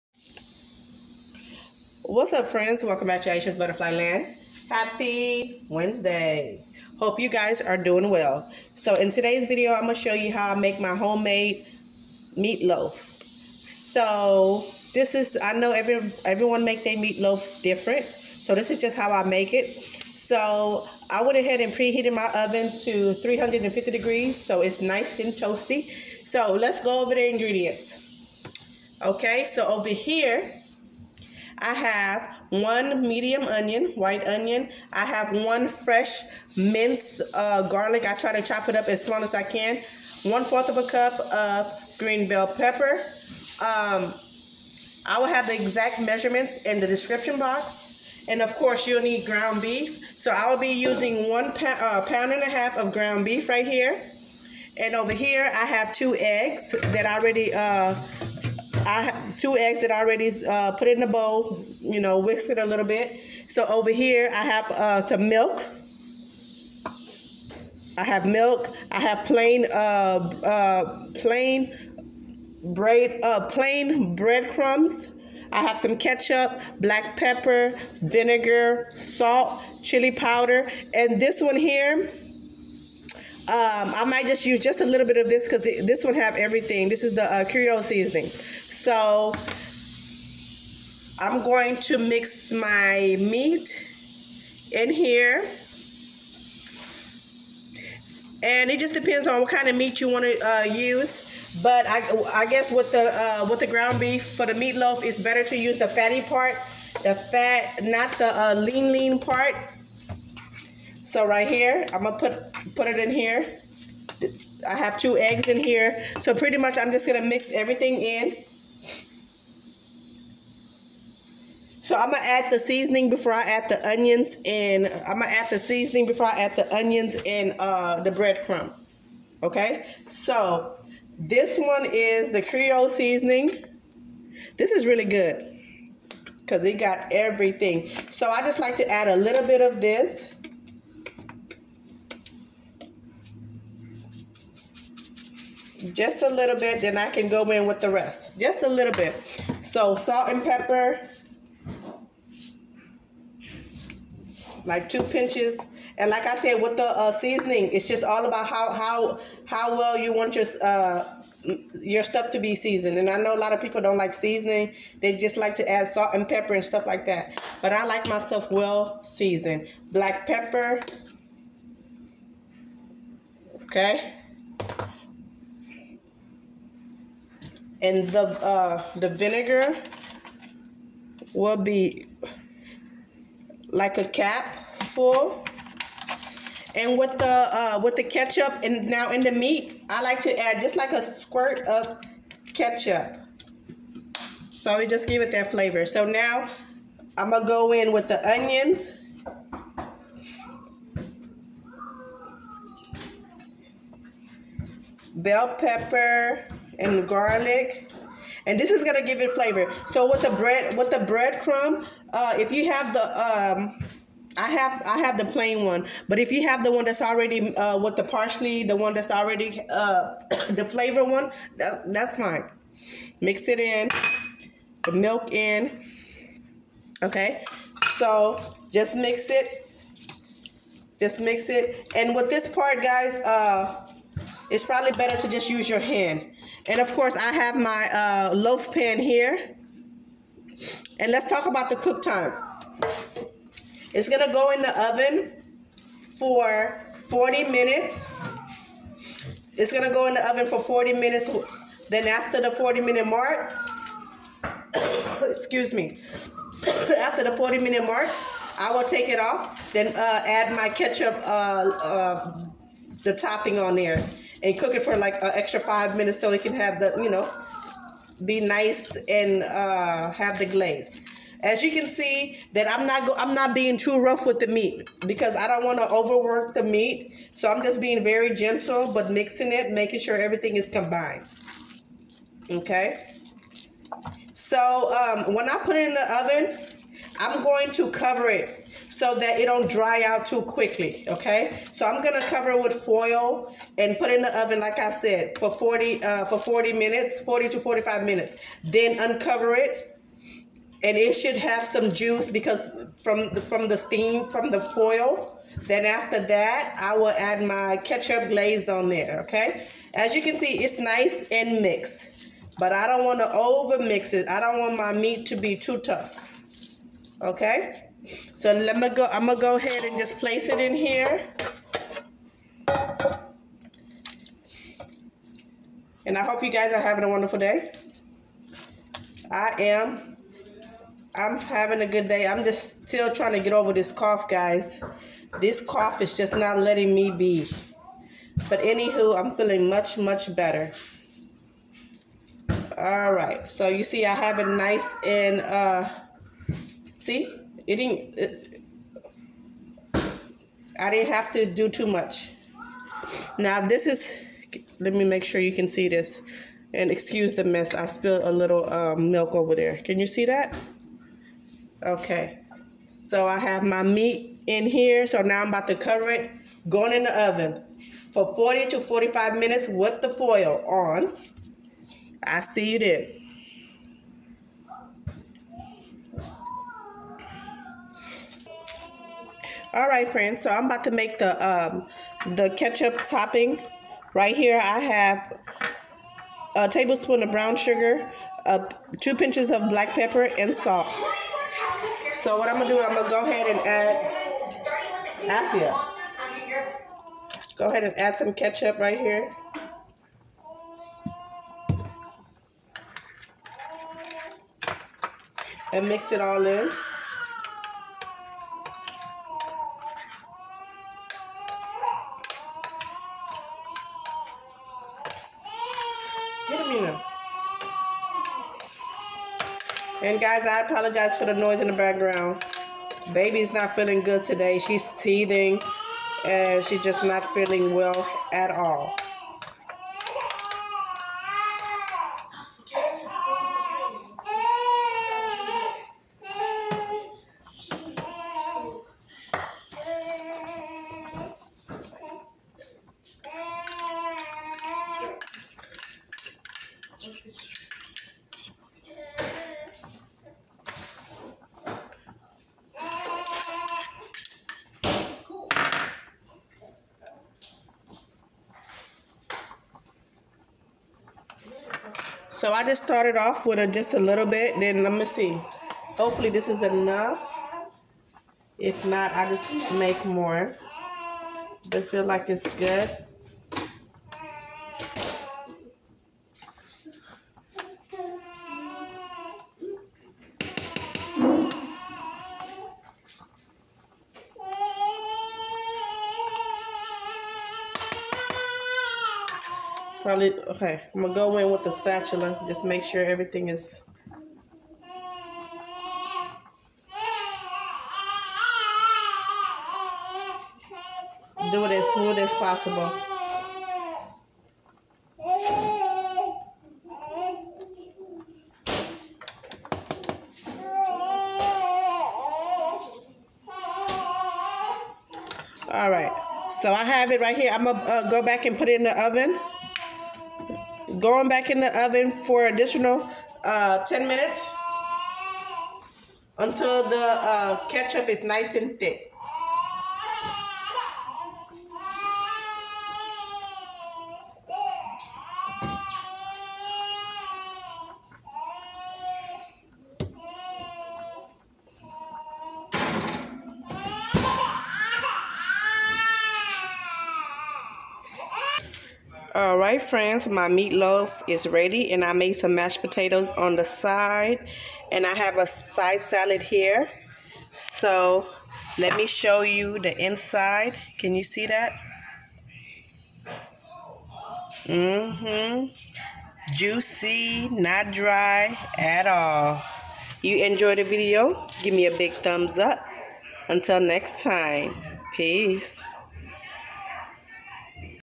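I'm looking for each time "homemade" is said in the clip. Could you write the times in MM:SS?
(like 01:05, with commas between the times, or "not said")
00:10.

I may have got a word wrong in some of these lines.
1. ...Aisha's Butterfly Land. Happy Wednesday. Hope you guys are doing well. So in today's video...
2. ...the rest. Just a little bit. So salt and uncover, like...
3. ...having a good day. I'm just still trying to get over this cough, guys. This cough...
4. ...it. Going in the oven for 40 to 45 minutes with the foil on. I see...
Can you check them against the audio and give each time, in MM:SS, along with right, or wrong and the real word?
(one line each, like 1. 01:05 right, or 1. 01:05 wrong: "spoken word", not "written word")
1. 00:03 right
2. 02:27 wrong: "pepper", not "uncover"
3. 05:31 right
4. 06:06 right.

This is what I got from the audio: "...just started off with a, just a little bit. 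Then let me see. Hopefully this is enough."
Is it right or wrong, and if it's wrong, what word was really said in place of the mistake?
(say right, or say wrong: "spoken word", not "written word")
right.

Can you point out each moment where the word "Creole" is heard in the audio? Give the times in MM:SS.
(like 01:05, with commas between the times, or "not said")
01:27, 02:12.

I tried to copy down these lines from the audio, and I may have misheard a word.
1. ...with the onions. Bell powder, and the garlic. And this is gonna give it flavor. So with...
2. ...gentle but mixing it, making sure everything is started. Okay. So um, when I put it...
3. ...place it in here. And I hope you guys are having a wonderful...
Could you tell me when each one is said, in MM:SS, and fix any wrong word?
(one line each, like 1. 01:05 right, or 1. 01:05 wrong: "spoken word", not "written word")
1. 03:17 wrong: "pepper", not "powder"
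2. 04:38 wrong: "combined", not "started"
3. 05:20 right.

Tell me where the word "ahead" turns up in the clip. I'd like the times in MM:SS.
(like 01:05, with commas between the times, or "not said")
00:21, 05:19, 06:33, 06:37.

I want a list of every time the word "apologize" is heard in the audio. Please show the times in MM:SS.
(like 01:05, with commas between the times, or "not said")
07:00.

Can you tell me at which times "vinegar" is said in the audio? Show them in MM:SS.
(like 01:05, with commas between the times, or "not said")
01:18, 02:59.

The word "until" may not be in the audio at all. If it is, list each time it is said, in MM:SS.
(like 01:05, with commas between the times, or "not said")
08:46, 09:33.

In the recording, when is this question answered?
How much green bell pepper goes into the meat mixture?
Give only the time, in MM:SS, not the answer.
00:40.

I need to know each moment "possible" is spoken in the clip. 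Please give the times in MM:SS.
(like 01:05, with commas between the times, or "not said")
08:22.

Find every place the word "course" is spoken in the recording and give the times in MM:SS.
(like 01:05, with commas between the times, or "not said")
00:48, 03:56.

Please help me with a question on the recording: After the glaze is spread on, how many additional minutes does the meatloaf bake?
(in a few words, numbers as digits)
10.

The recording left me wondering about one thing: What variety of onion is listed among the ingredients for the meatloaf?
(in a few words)
White onion.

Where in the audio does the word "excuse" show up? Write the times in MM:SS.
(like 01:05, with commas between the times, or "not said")
04:15, 05:56.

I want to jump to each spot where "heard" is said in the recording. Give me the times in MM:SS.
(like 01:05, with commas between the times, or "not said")
not said.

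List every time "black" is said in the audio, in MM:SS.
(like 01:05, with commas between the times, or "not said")
01:16, 02:49, 06:29.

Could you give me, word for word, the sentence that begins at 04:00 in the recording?
And let's talk about the cook time.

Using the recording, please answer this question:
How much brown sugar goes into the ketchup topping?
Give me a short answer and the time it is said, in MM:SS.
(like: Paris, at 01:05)
A tablespoon, at 06:26.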